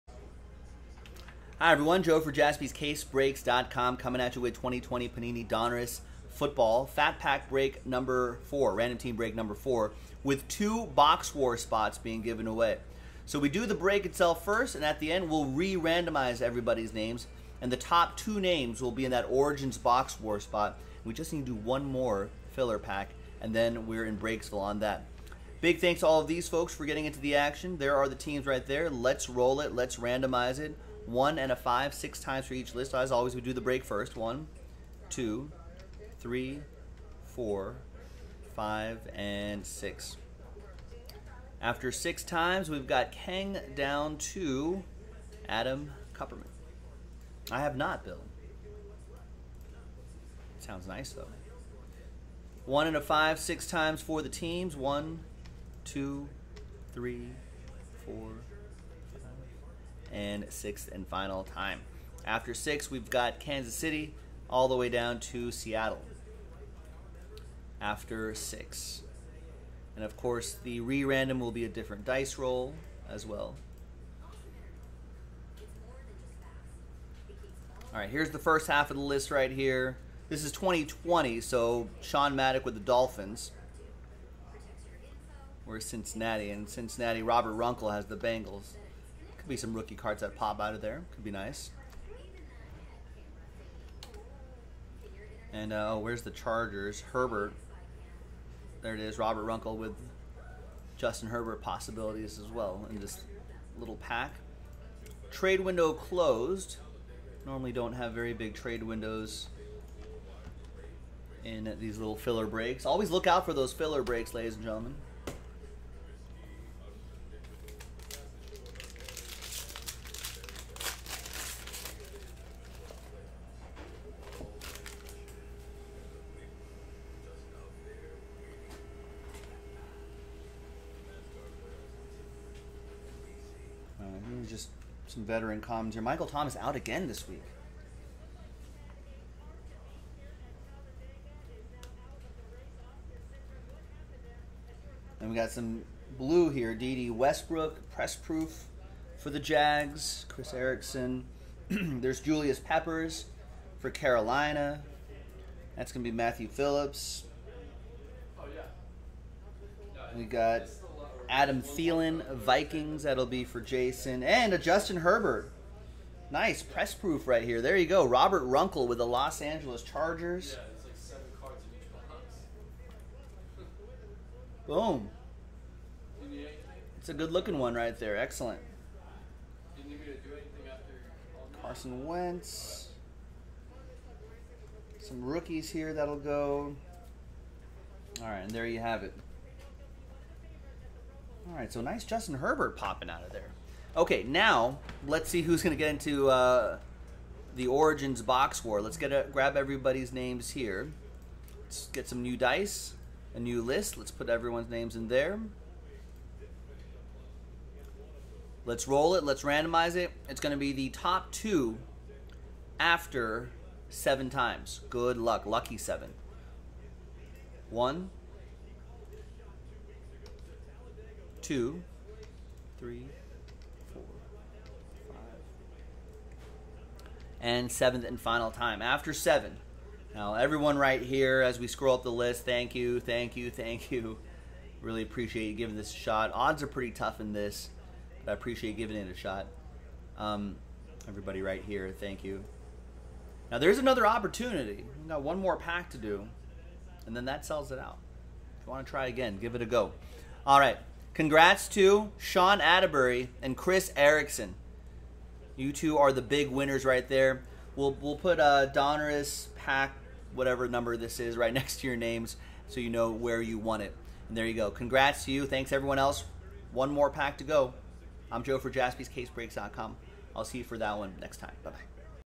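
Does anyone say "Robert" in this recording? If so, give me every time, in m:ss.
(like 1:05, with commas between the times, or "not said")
1:27, 1:39, 2:48.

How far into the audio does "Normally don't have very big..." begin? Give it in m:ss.
1:47.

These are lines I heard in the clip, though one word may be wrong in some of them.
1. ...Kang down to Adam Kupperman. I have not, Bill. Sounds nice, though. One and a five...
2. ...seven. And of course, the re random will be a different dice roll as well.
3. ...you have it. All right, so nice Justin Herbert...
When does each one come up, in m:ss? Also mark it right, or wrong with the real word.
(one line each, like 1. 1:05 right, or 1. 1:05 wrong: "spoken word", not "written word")
1. 0:43 right
2. 1:08 wrong: "six", not "seven"
3. 3:08 right.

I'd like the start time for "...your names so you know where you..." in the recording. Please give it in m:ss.
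4:21.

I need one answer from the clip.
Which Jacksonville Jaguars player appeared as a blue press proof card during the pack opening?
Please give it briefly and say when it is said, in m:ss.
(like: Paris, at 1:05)
DD Westbrook, at 2:26.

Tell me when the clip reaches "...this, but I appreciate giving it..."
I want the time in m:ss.
3:57.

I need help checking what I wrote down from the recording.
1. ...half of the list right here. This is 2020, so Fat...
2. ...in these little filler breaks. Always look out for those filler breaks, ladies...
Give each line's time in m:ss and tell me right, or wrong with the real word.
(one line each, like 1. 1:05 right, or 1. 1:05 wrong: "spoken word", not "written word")
1. 1:18 wrong: "Sean", not "Fat"
2. 1:51 right.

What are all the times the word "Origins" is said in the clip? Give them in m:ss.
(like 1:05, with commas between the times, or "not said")
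0:19, 3:17.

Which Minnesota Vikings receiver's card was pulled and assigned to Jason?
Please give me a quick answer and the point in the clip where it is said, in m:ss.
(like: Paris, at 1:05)
Adam Thielen, at 2:41.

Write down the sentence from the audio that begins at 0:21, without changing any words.
We just need to do one more filler pack, and then we're in Breaksville on that.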